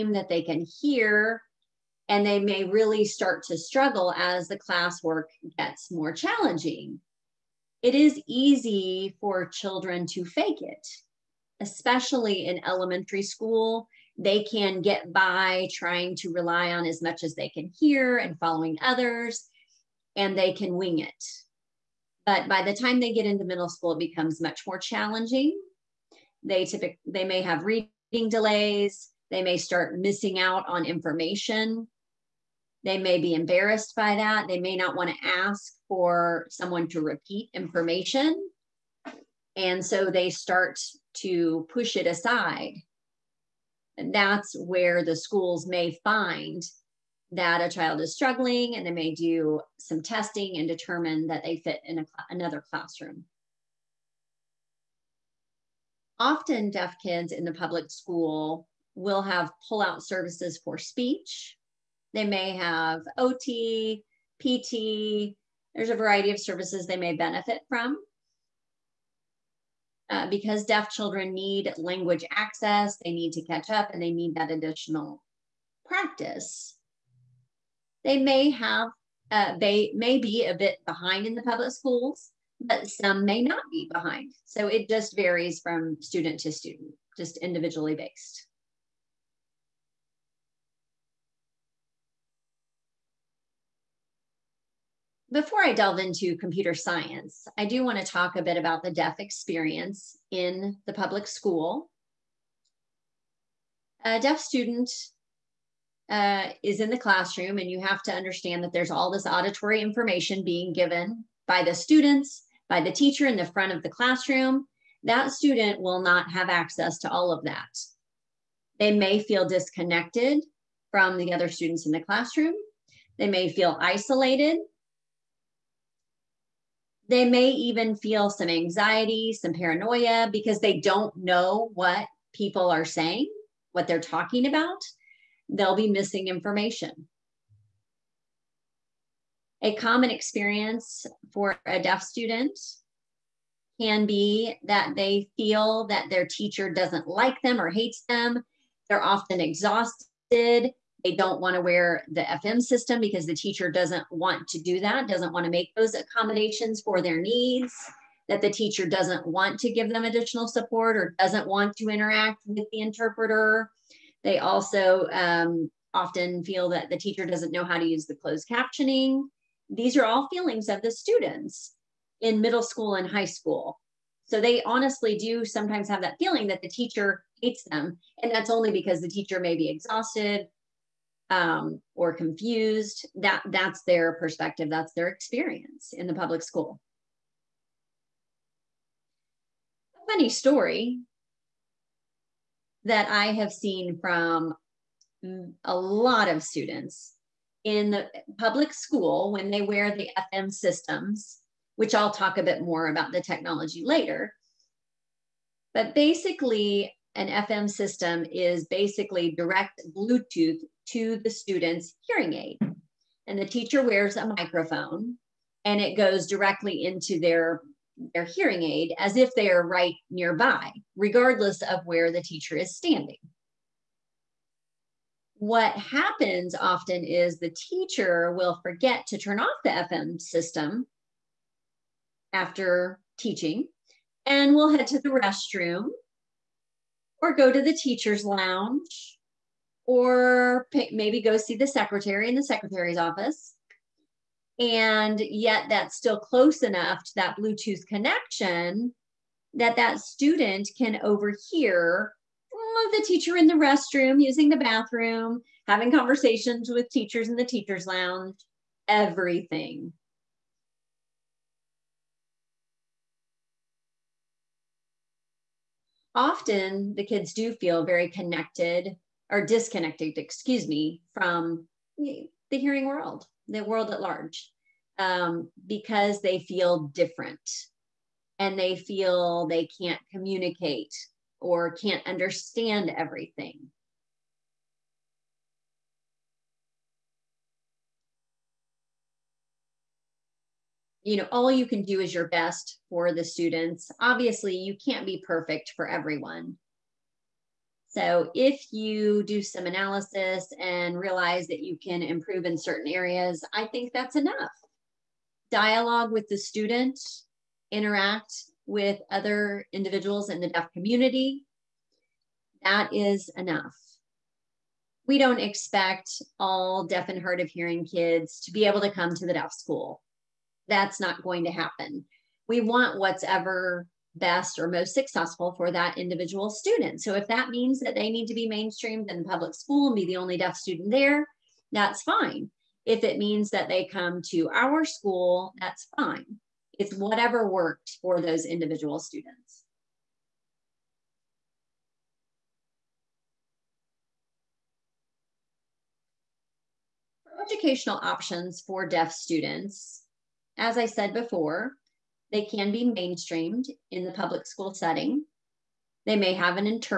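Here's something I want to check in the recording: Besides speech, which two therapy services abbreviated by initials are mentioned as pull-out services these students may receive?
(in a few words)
OT, PT.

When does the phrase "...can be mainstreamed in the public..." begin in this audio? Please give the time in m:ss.
5:52.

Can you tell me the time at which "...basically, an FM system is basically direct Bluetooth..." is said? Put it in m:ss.
3:25.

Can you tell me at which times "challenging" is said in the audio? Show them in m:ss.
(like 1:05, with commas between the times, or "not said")
0:06, 0:24.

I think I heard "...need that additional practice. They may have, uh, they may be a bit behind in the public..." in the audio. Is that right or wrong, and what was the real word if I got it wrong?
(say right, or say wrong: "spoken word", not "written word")
right.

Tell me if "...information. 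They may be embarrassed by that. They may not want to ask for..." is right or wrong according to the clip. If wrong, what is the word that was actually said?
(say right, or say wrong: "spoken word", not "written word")
right.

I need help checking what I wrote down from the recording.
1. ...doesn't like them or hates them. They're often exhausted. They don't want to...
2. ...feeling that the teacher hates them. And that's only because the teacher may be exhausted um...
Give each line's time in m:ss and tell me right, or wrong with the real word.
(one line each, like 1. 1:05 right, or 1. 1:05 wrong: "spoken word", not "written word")
1. 2:26 right
2. 2:56 right.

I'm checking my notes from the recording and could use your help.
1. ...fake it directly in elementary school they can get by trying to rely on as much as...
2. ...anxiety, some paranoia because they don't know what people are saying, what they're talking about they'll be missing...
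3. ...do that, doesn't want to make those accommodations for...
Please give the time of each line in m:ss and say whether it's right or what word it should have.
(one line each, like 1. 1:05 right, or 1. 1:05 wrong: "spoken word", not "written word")
1. 0:10 wrong: "especially", not "directly"
2. 2:08 right
3. 2:34 right.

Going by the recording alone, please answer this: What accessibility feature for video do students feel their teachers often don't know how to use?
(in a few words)
closed captioning.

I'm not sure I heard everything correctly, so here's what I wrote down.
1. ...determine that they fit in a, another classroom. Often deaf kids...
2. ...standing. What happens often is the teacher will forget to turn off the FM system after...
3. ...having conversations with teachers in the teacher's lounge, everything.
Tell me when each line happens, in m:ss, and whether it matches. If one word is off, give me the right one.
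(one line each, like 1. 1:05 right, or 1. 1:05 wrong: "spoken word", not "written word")
1. 0:50 right
2. 3:42 right
3. 4:15 right.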